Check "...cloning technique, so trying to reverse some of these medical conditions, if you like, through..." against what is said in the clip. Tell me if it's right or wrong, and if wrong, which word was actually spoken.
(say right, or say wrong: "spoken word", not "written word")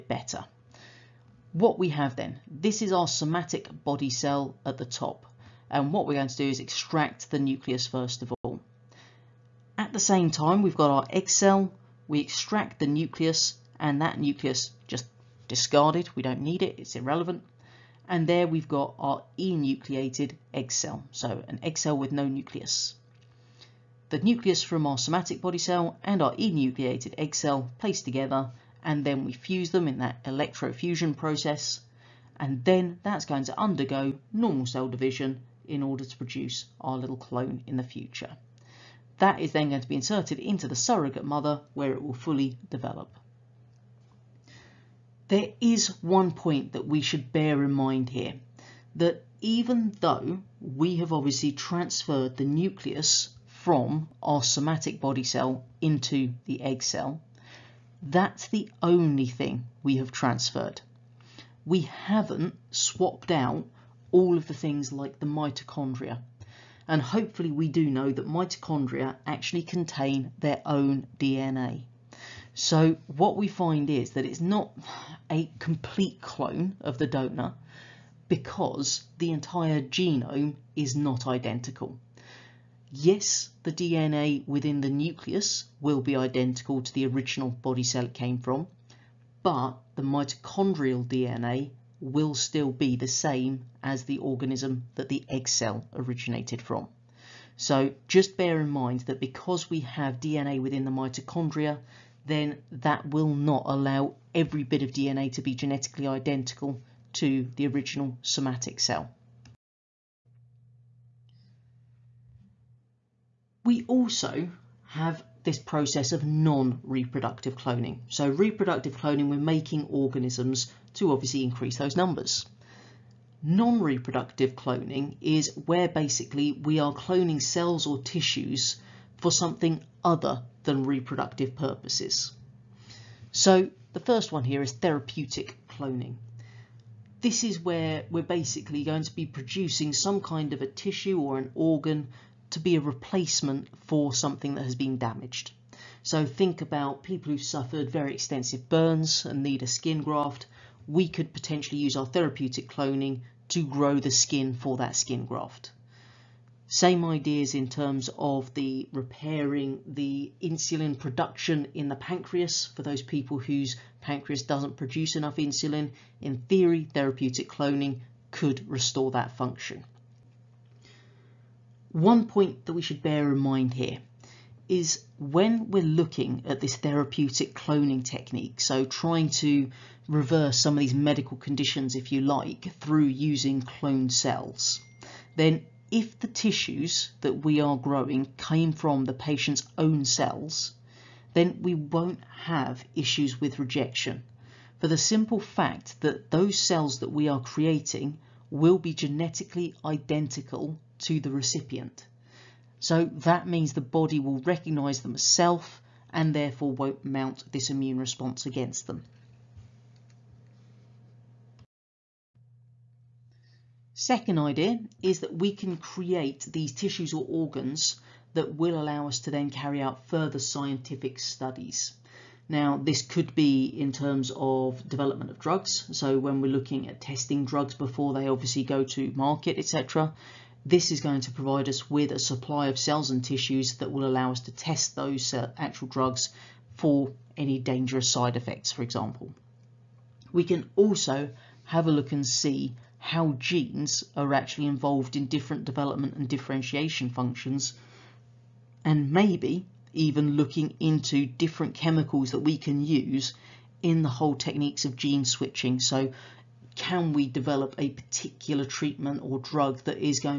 right.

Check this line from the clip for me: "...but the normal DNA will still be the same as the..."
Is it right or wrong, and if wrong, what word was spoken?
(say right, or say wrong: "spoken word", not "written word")
wrong: "mitochondrial", not "normal".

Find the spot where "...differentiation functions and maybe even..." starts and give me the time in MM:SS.
04:06.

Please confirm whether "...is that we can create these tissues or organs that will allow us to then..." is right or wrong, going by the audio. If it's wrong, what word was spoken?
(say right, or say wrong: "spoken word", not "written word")
right.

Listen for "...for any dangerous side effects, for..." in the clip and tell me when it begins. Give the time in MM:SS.
03:56.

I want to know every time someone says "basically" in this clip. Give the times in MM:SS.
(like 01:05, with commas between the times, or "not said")
02:05, 02:18.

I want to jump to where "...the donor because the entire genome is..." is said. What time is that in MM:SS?
01:16.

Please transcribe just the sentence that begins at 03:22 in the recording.
So that means the body will recognize them as self and therefore won't mount this immune response against them.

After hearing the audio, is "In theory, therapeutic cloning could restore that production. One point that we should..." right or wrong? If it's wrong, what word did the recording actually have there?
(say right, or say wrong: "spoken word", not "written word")
wrong: "function", not "production".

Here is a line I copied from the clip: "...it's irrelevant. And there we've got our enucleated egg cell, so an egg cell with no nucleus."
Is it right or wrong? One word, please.
right.